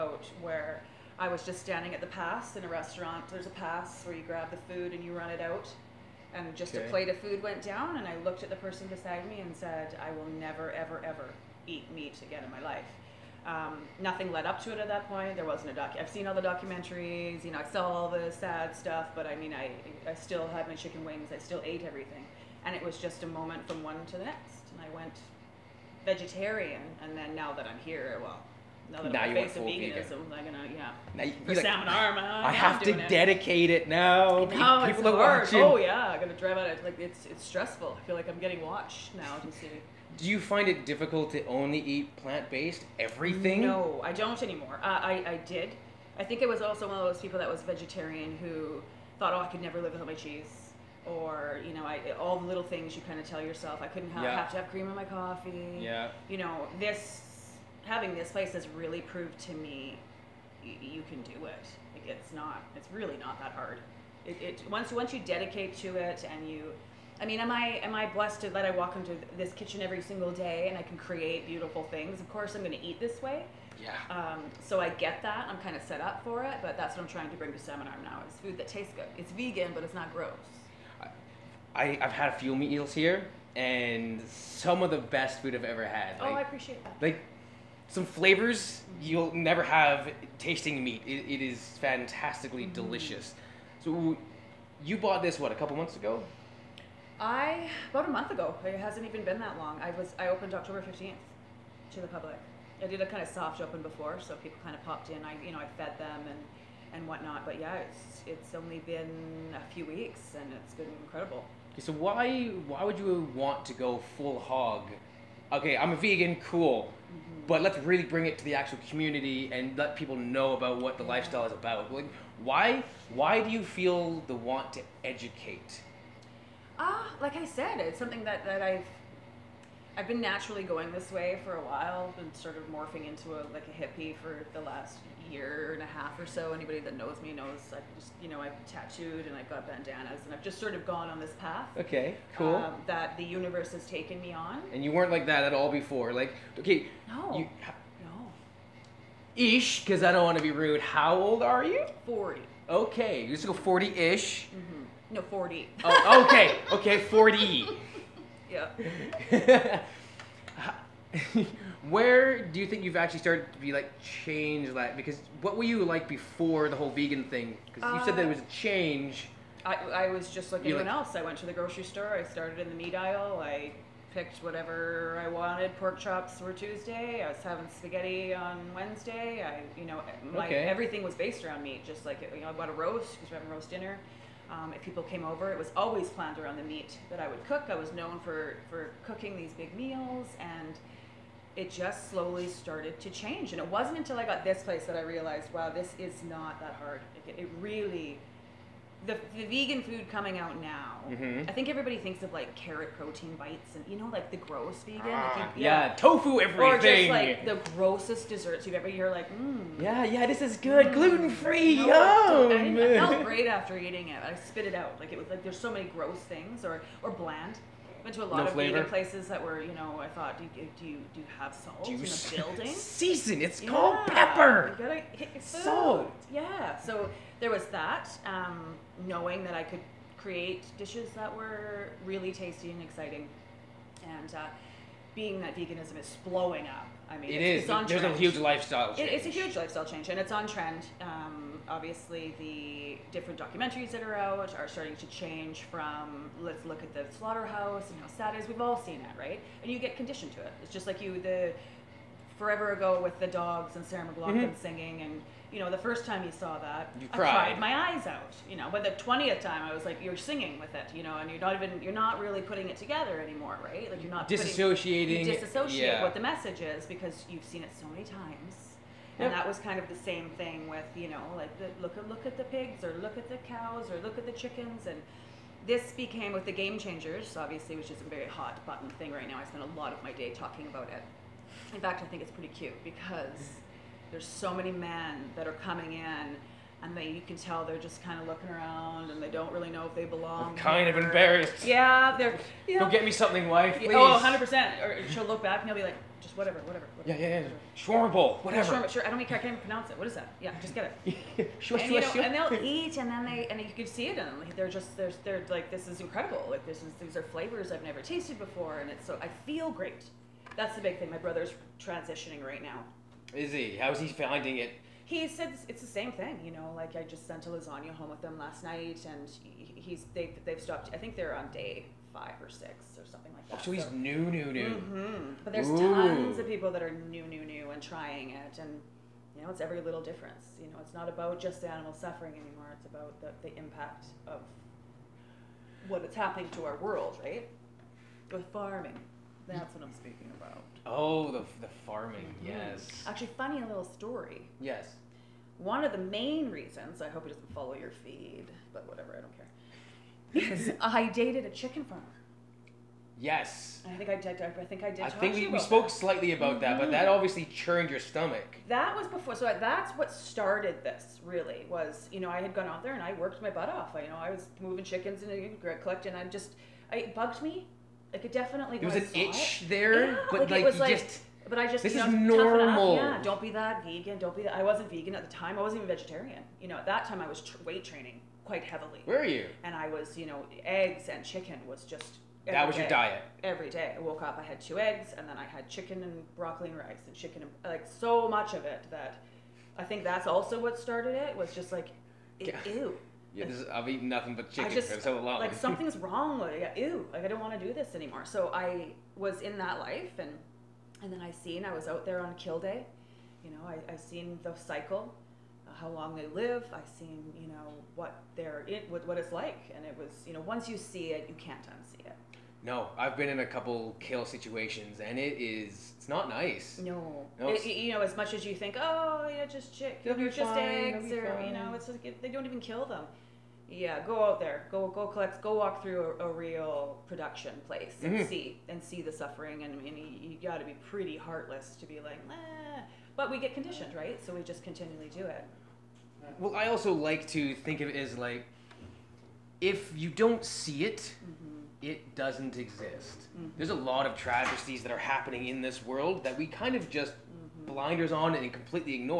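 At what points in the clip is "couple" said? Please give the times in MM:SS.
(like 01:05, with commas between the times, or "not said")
01:35, 06:53.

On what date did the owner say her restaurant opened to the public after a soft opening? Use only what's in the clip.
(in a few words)
October 15.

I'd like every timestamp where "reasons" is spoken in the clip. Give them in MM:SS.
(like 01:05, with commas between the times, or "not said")
05:46.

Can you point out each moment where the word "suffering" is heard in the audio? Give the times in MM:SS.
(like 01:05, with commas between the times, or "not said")
05:31, 07:09.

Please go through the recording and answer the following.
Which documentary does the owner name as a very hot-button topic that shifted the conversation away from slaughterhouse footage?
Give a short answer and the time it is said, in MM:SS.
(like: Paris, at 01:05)
The Game Changers, at 04:36.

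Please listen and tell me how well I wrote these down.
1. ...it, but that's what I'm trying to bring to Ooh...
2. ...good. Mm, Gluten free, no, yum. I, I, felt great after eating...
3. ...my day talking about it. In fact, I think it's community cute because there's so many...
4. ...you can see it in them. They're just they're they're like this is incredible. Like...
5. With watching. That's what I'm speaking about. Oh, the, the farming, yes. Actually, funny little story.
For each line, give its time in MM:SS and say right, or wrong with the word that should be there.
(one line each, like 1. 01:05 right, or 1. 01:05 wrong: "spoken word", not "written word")
1. 01:16 wrong: "Salmon", not "Ooh"
2. 03:30 right
3. 04:40 wrong: "pretty", not "community"
4. 05:03 right
5. 05:38 wrong: "farming", not "watching".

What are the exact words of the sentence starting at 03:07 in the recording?
I was known for, for cooking these big meals and it just slowly started to change.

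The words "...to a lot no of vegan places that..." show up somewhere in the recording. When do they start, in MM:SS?
03:38.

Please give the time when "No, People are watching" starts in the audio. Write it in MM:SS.
00:34.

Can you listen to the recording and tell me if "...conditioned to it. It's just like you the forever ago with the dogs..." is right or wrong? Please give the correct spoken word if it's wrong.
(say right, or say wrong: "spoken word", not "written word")
right.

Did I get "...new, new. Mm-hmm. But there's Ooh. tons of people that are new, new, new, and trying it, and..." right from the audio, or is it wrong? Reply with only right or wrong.
right.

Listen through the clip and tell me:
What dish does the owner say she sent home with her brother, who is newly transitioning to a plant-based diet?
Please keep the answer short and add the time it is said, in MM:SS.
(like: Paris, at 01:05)
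Lasagna, at 05:17.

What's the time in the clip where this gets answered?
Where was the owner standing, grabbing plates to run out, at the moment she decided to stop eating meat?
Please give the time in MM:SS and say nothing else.
00:01.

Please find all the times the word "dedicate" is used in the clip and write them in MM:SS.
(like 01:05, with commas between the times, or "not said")
00:33, 01:05.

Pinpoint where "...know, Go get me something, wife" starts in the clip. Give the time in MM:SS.
04:52.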